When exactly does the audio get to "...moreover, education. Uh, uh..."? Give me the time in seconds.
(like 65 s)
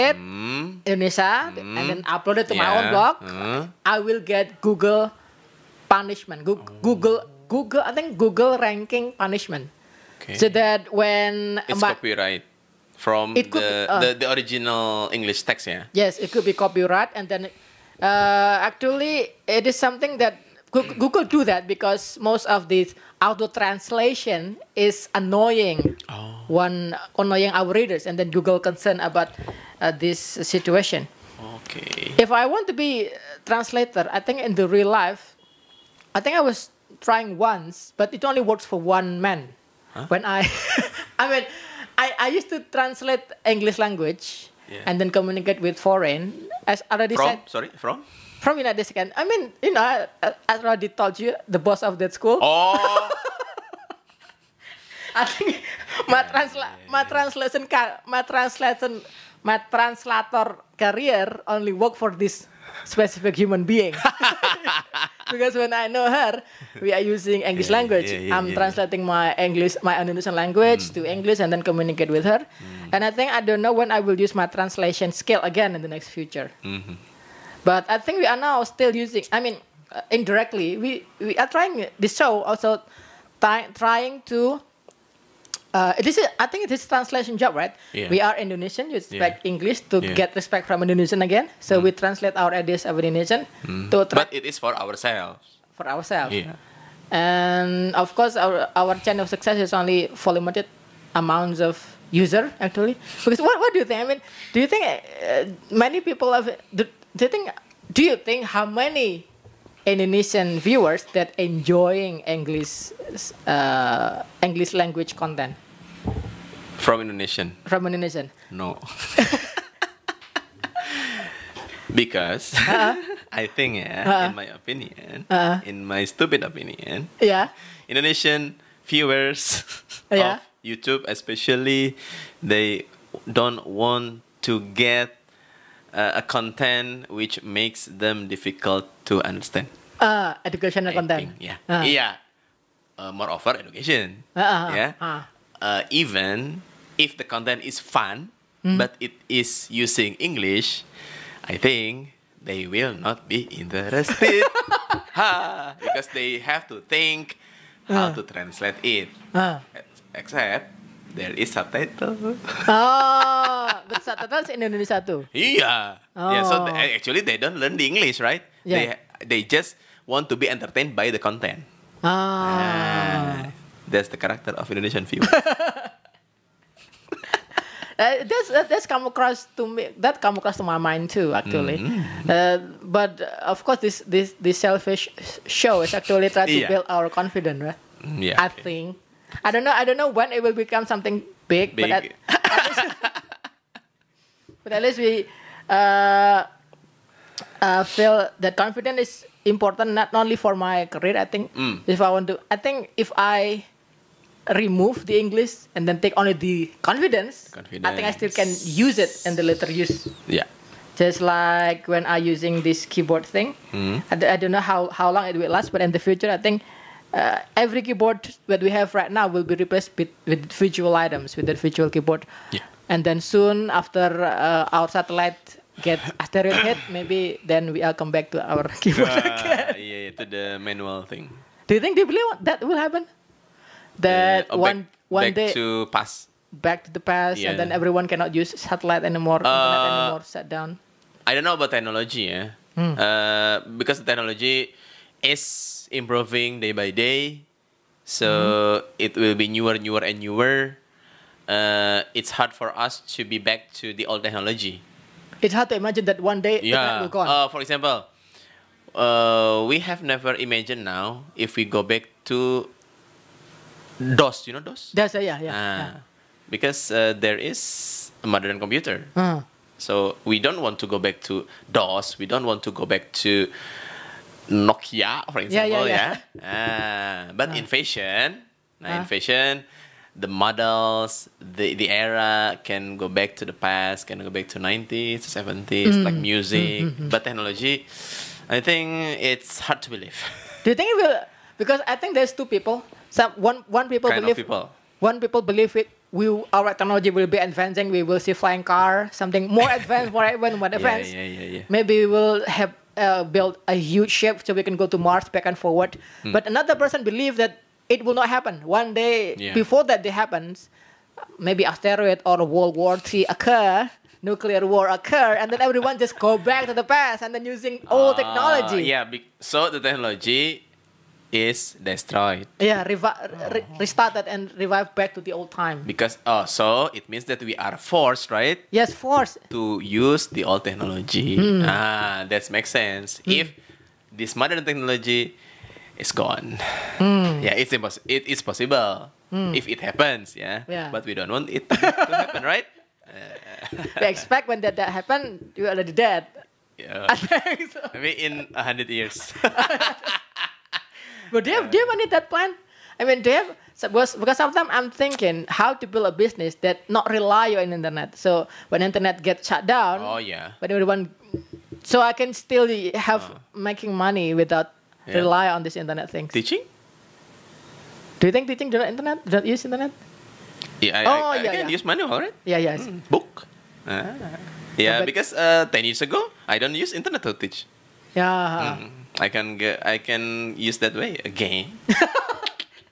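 143 s.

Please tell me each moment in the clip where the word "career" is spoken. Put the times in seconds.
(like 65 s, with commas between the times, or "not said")
60 s, 200 s.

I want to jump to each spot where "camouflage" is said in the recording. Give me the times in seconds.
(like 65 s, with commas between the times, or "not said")
not said.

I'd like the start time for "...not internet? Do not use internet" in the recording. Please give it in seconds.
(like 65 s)
368 s.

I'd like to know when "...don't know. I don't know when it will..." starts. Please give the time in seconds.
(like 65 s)
189 s.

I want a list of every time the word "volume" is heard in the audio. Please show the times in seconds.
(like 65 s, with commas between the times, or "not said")
not said.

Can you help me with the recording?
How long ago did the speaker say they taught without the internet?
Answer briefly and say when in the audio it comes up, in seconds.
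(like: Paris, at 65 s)
10 years, at 375 s.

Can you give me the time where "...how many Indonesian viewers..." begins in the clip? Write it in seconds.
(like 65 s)
108 s.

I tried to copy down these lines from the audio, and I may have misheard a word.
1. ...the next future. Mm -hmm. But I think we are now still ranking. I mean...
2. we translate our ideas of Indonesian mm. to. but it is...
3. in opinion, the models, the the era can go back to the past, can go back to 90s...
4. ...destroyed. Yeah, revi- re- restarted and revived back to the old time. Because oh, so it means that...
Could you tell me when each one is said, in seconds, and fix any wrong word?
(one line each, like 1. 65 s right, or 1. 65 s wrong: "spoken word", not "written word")
1. 75 s wrong: "using", not "ranking"
2. 91 s right
3. 278 s wrong: "fashion", not "opinion"
4. 321 s right.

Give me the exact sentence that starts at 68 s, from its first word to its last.
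Yeah, yeah, I'm translating my English, my Indonesian language mm.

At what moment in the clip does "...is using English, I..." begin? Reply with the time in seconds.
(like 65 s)
149 s.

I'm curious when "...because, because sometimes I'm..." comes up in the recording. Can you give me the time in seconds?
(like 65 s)
353 s.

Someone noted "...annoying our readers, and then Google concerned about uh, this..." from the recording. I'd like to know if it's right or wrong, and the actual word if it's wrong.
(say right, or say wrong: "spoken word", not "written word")
right.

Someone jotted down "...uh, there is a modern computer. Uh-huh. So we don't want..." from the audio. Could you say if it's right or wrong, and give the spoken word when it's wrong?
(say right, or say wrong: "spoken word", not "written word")
right.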